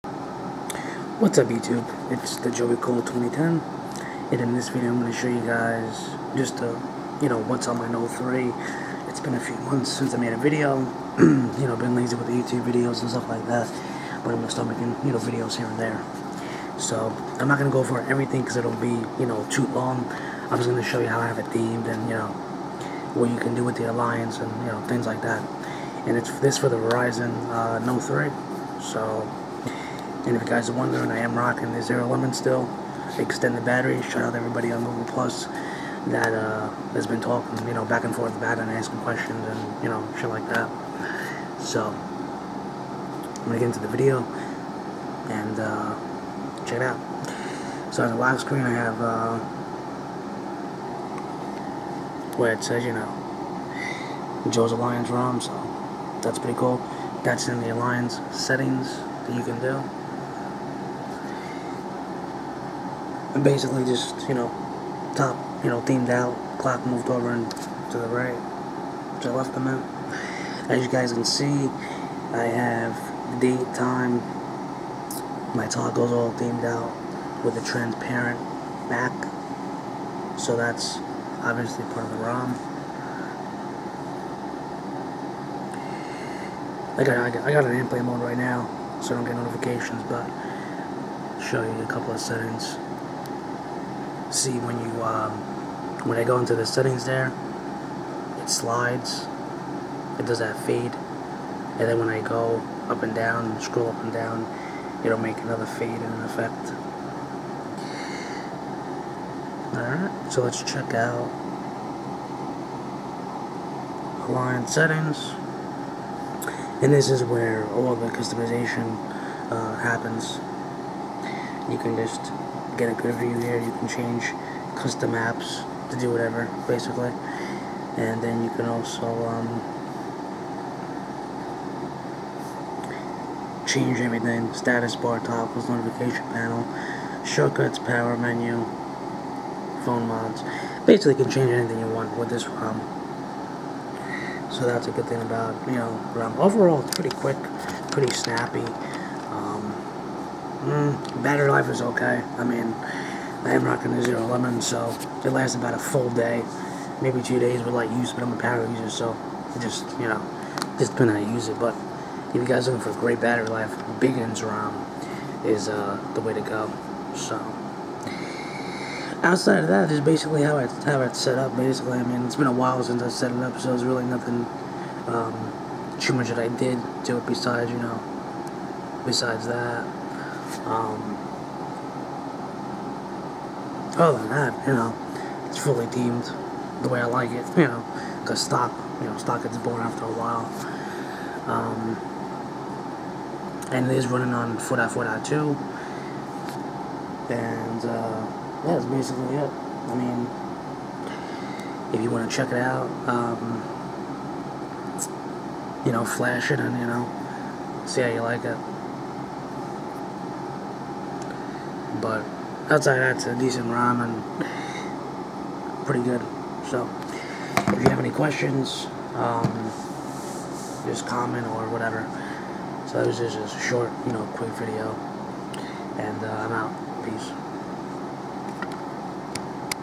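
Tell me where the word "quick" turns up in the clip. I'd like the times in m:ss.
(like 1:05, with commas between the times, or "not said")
2:27, 3:44.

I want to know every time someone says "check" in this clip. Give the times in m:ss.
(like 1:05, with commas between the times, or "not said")
0:46, 1:50, 3:22.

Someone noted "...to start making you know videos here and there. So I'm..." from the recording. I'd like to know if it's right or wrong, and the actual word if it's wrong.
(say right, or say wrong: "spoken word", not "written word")
right.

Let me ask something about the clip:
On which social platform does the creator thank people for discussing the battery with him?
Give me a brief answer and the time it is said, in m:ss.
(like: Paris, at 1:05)
Google Plus, at 0:34.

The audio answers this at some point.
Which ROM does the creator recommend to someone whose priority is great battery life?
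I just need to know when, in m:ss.
2:43.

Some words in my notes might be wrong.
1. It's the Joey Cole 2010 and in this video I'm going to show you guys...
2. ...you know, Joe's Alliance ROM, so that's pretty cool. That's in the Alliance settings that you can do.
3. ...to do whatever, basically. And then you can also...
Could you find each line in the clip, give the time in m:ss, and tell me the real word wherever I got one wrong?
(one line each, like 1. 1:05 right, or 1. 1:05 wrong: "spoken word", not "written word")
1. 0:02 right
2. 0:52 right
3. 2:05 right.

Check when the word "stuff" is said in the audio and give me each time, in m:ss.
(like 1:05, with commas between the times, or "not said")
0:13.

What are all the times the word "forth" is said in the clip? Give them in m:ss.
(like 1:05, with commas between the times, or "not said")
0:38.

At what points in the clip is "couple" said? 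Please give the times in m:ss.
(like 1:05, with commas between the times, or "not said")
1:31.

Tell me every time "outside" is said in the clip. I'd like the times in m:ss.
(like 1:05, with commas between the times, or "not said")
2:49, 3:32.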